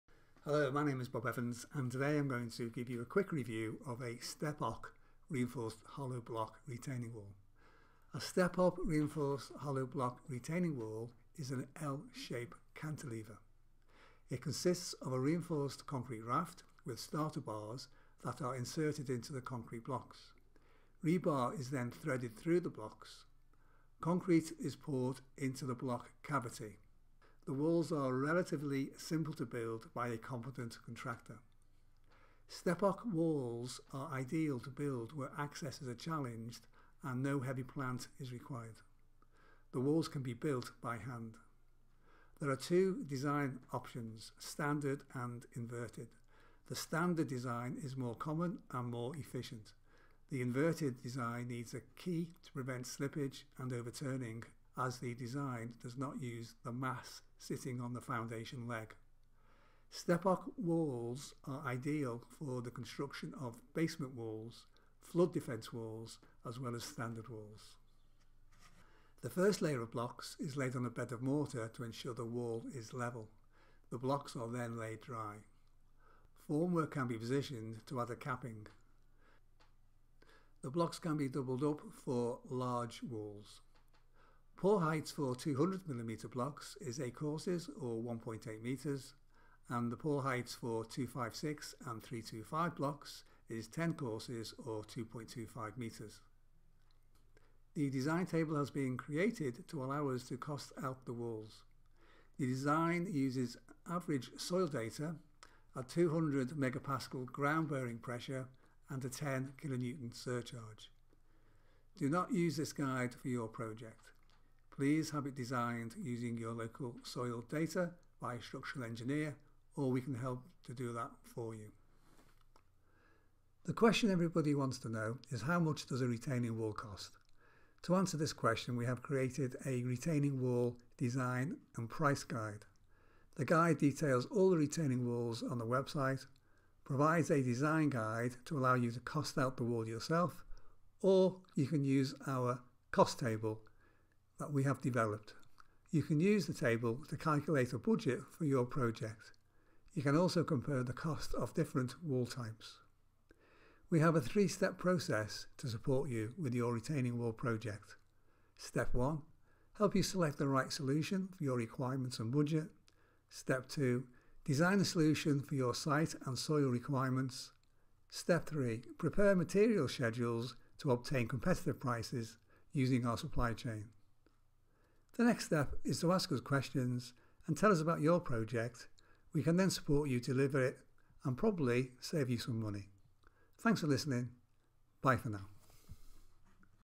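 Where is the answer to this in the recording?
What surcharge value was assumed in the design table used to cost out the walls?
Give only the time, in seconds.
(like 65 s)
109 s.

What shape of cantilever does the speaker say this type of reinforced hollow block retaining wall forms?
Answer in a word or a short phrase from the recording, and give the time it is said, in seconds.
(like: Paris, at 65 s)
L-shaped, at 11 s.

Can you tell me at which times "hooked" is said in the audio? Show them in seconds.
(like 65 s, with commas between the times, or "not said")
not said.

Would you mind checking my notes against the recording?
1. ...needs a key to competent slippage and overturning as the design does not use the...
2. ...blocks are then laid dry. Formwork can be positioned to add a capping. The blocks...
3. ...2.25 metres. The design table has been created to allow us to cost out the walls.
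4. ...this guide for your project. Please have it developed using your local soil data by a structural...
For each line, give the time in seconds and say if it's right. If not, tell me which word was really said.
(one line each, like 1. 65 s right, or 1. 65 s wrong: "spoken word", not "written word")
1. 51 s wrong: "prevent", not "competent"
2. 73 s right
3. 94 s right
4. 112 s wrong: "designed", not "developed".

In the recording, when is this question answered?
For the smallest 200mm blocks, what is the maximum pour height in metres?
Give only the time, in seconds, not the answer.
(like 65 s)
88 s.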